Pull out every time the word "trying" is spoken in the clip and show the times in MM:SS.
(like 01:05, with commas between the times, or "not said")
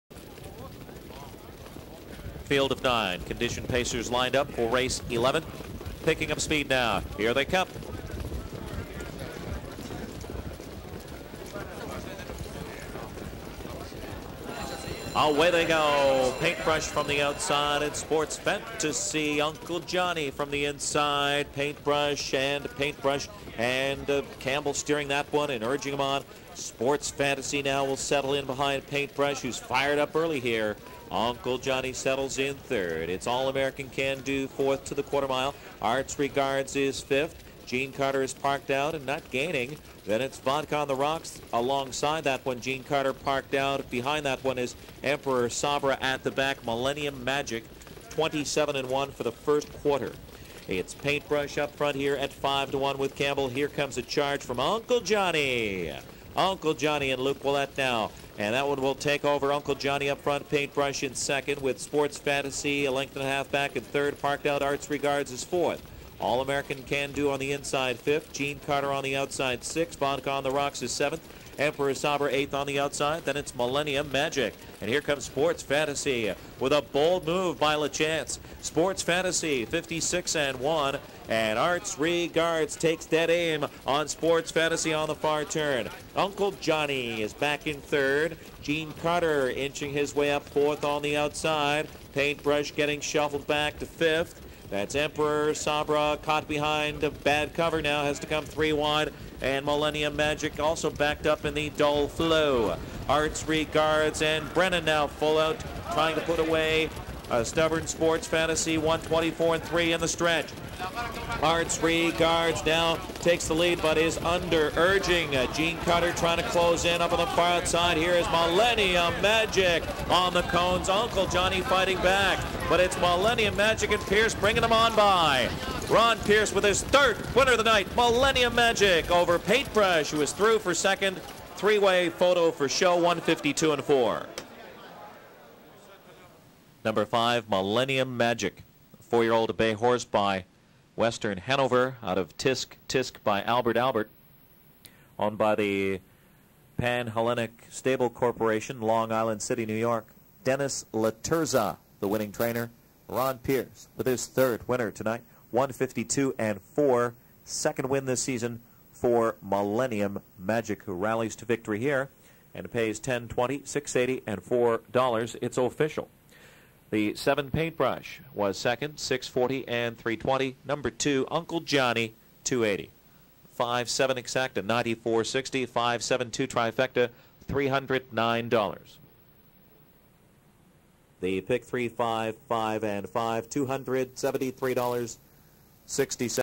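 01:45, 01:56.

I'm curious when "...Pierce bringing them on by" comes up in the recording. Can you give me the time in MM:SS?
02:04.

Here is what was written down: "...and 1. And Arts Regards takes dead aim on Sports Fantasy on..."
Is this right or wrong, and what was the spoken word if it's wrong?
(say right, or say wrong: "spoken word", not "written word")
right.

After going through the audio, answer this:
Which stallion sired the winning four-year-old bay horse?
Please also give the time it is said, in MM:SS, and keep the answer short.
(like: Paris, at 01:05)
Western Hanover, at 02:21.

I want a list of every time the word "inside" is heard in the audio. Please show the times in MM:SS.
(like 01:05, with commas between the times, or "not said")
00:20, 01:07.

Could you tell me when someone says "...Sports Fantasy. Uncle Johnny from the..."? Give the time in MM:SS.
00:17.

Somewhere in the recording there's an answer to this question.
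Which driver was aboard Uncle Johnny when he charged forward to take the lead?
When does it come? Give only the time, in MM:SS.
00:57.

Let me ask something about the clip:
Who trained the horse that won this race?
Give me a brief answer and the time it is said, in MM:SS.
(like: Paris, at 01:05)
Dennis Laterza, at 02:30.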